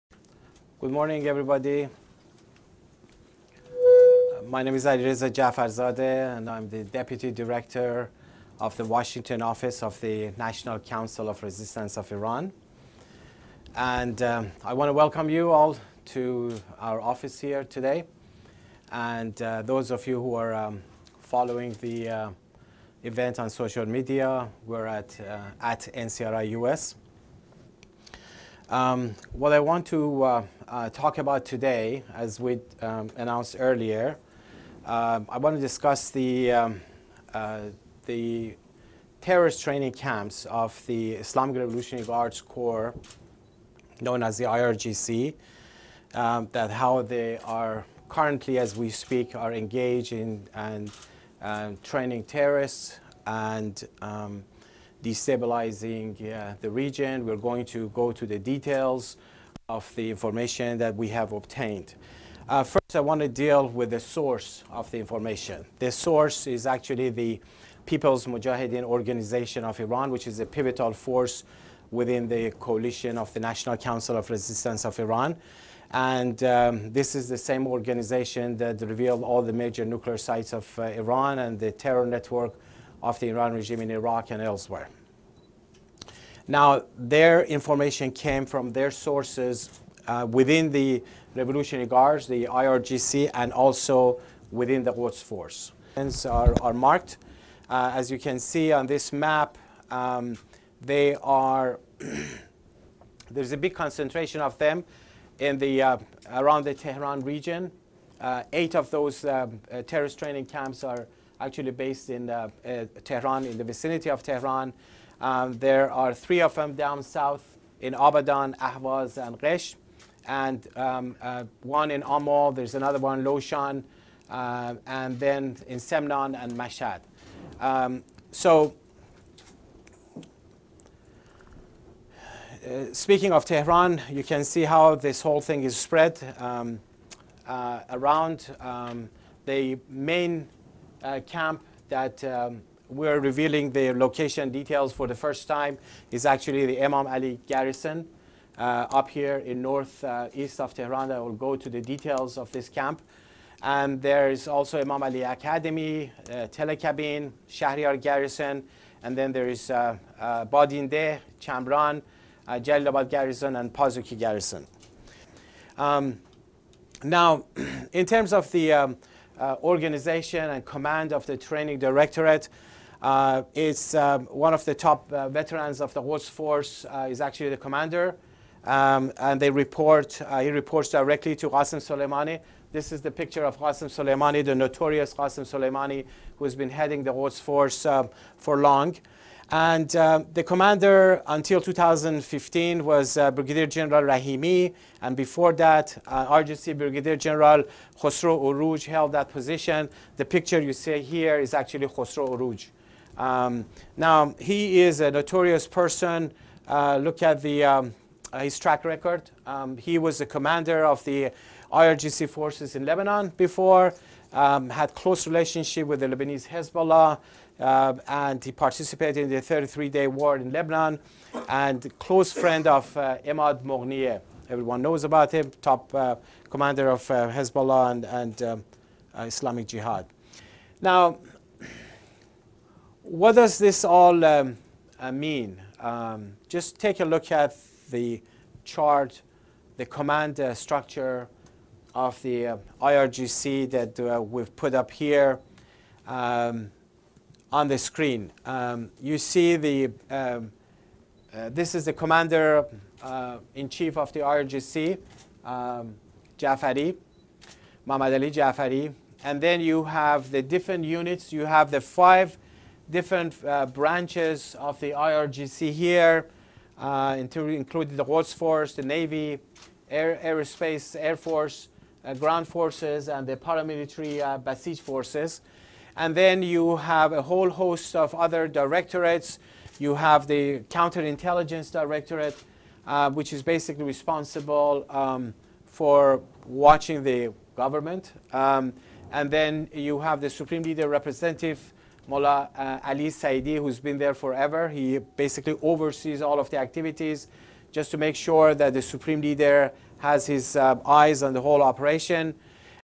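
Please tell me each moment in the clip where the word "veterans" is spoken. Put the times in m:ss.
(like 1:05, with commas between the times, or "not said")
2:55.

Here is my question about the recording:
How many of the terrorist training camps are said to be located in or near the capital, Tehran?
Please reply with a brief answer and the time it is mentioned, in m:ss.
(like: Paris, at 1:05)
8, at 1:48.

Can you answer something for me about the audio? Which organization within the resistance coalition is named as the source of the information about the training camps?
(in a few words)
People's Mujahideen Organization of Iran.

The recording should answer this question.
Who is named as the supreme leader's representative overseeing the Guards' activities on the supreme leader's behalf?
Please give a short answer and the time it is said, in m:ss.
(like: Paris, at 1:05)
Ali Saidi, at 4:52.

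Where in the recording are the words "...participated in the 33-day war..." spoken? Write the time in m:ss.
3:38.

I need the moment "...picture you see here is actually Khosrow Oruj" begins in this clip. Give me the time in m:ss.
3:20.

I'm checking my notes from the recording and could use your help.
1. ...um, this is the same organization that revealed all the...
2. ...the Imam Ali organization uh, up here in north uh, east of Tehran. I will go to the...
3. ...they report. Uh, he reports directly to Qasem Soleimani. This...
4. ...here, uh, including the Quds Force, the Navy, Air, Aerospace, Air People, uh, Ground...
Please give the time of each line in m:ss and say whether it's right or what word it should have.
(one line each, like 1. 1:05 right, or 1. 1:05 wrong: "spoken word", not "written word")
1. 1:16 right
2. 2:26 wrong: "garrison", not "organization"
3. 2:59 right
4. 4:25 wrong: "Force", not "People".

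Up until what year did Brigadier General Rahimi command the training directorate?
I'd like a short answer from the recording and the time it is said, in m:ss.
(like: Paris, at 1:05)
2015, at 3:11.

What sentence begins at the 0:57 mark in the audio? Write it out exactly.
We're going to go to the details of the information that we have obtained.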